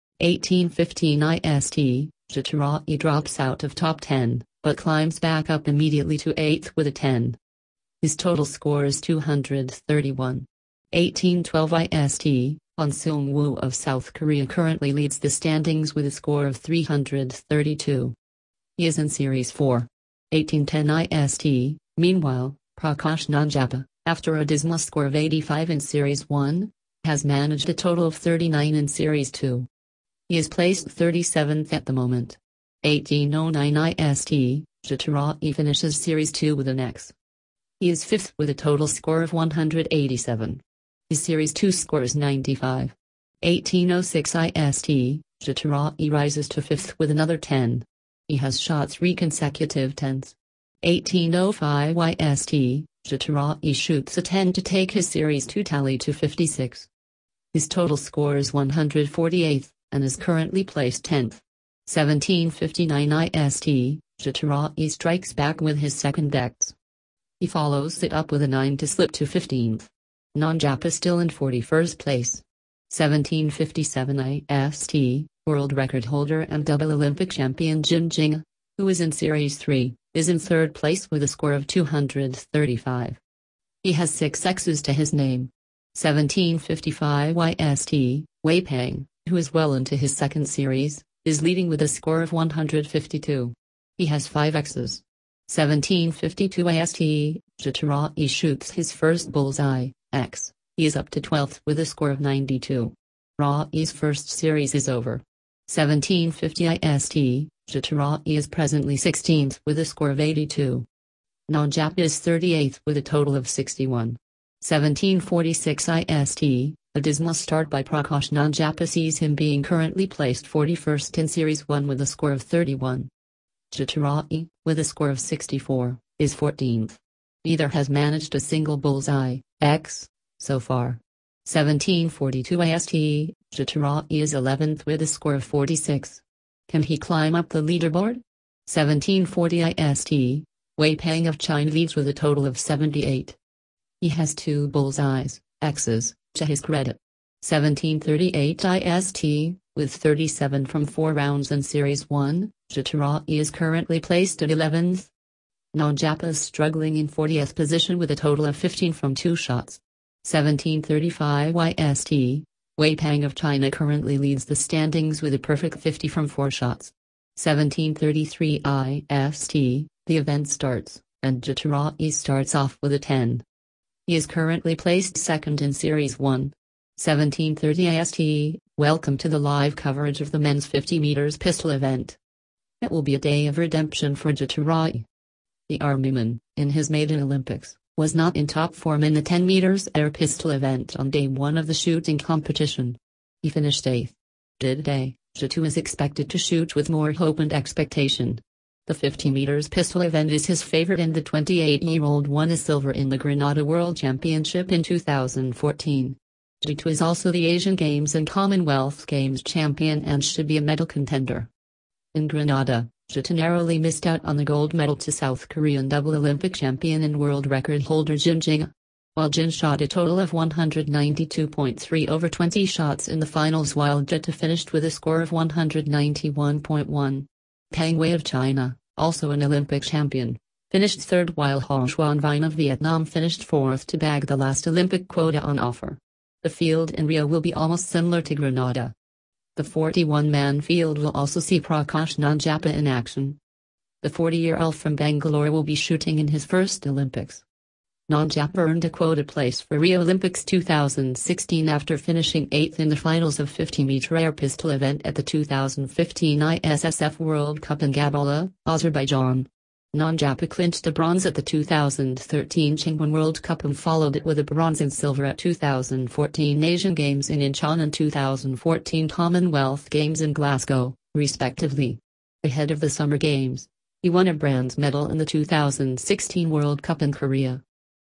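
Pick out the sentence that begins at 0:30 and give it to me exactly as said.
He is placed 37th at the moment.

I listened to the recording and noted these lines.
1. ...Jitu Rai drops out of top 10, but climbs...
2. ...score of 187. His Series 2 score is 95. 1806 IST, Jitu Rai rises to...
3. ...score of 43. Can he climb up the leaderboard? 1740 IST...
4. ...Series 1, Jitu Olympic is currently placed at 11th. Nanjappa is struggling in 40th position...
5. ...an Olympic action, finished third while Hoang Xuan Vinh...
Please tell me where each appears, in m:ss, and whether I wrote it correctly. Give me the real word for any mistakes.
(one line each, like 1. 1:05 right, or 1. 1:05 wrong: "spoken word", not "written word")
1. 0:02 right
2. 0:38 right
3. 2:15 wrong: "46", not "43"
4. 2:31 wrong: "Rai", not "Olympic"
5. 3:49 wrong: "champion", not "action".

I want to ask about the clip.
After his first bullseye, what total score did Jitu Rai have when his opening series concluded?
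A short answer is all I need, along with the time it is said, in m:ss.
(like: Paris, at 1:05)
92, at 1:42.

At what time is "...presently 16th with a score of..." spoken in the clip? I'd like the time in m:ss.
1:48.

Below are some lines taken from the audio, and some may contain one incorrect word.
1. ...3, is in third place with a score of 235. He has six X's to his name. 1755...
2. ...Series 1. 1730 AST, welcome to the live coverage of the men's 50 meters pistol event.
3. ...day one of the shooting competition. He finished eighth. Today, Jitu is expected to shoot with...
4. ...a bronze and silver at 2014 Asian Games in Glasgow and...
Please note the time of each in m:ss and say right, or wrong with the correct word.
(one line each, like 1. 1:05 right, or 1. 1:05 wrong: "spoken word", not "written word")
1. 1:19 right
2. 2:55 right
3. 3:11 right
4. 4:24 wrong: "Incheon", not "Glasgow".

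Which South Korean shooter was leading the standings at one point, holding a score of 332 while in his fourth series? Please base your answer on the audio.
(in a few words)
On Seung Woo.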